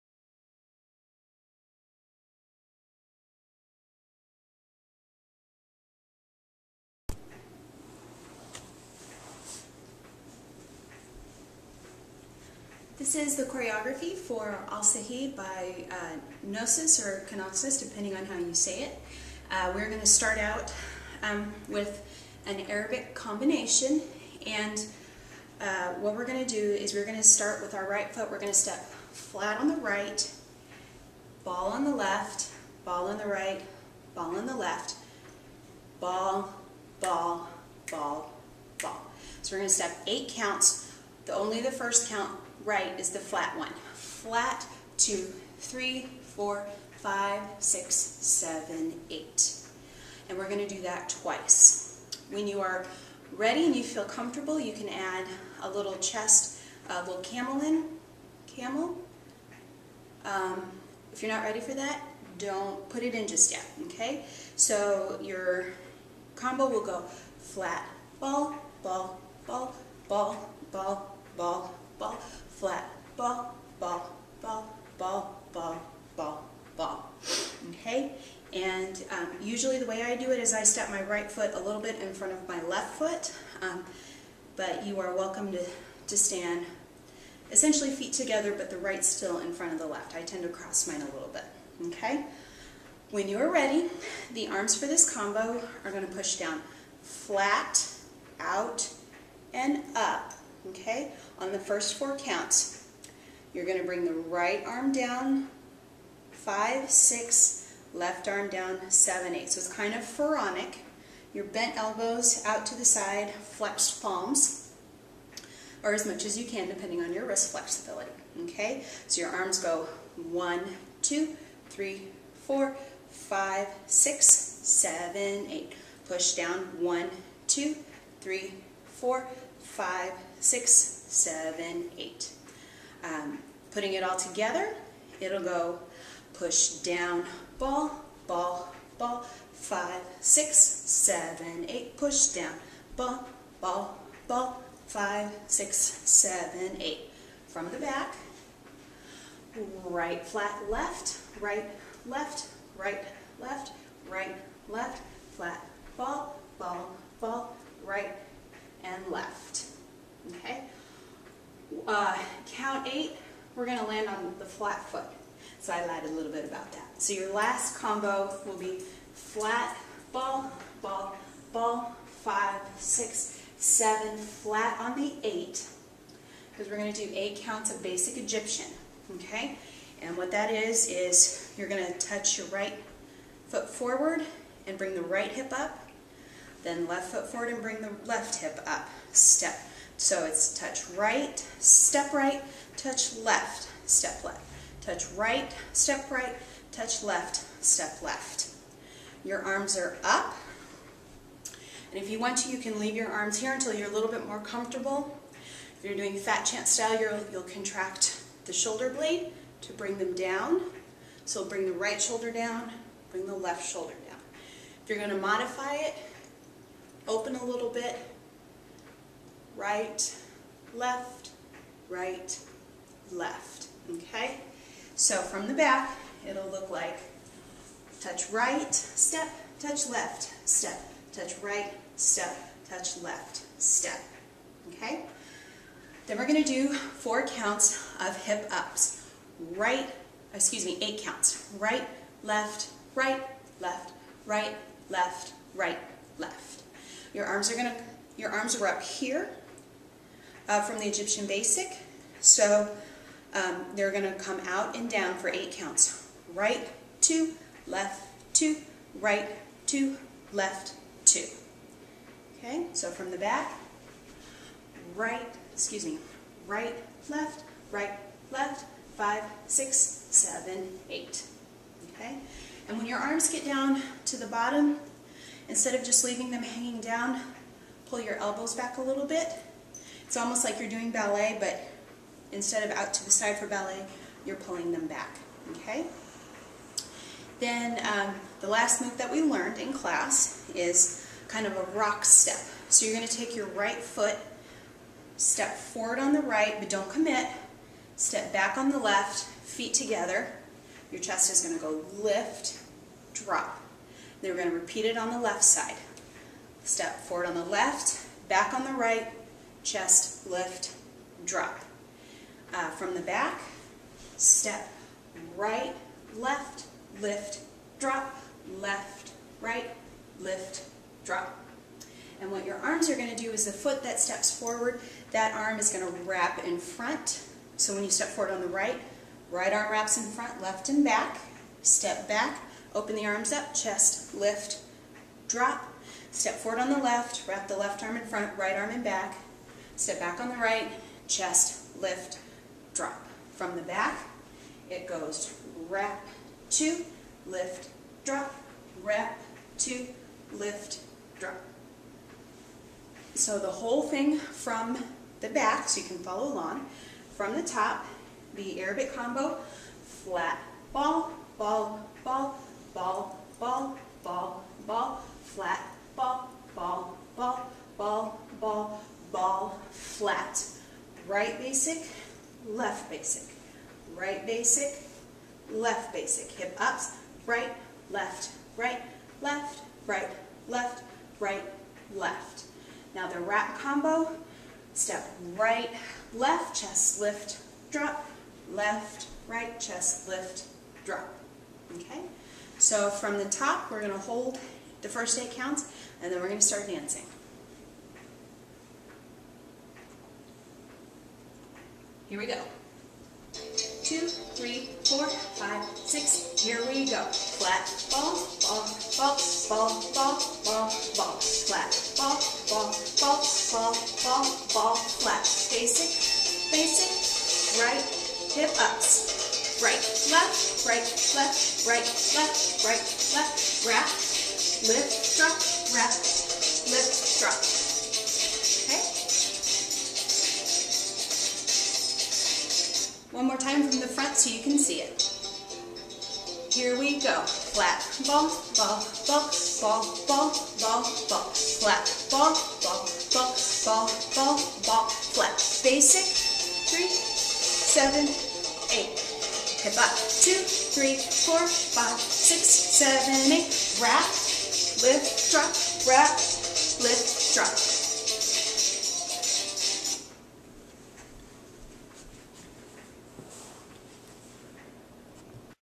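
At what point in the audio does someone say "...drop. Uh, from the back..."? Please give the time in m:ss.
5:11.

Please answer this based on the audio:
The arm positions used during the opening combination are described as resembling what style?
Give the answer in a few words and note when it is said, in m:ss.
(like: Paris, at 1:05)
Pharaonic, at 1:50.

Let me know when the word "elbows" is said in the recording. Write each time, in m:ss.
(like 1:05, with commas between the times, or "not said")
1:51, 4:38.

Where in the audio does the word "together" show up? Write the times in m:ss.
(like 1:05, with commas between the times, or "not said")
1:28, 2:14, 4:59.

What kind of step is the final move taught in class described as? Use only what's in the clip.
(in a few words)
Rock step.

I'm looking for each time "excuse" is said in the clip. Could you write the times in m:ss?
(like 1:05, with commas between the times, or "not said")
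4:00, 4:25.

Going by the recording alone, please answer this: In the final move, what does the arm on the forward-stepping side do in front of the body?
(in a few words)
Wraps.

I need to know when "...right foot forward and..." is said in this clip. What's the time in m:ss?
3:02.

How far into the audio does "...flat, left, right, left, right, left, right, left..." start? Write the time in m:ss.
2:30.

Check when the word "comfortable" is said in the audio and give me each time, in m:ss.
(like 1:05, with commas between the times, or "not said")
0:54, 3:24.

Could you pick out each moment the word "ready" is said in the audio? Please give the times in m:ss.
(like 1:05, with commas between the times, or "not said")
0:53, 1:01, 1:33.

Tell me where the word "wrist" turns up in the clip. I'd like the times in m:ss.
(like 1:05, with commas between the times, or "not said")
1:57.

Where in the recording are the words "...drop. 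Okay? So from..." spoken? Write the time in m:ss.
6:30.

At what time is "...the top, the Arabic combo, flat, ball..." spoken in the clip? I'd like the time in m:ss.
5:57.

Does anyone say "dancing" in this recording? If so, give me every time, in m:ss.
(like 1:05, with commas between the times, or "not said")
6:36.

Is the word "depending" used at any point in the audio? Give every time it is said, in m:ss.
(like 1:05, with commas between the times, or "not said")
0:17, 1:56.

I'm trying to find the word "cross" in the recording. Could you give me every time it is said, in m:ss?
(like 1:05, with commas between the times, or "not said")
1:30.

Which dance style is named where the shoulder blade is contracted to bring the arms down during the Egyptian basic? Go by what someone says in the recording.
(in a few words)
FatChance style.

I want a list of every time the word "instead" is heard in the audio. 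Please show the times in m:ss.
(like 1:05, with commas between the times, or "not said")
4:35, 4:42.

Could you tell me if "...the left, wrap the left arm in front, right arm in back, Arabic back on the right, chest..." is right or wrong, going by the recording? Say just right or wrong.
wrong.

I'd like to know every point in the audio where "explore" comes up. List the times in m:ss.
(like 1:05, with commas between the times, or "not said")
not said.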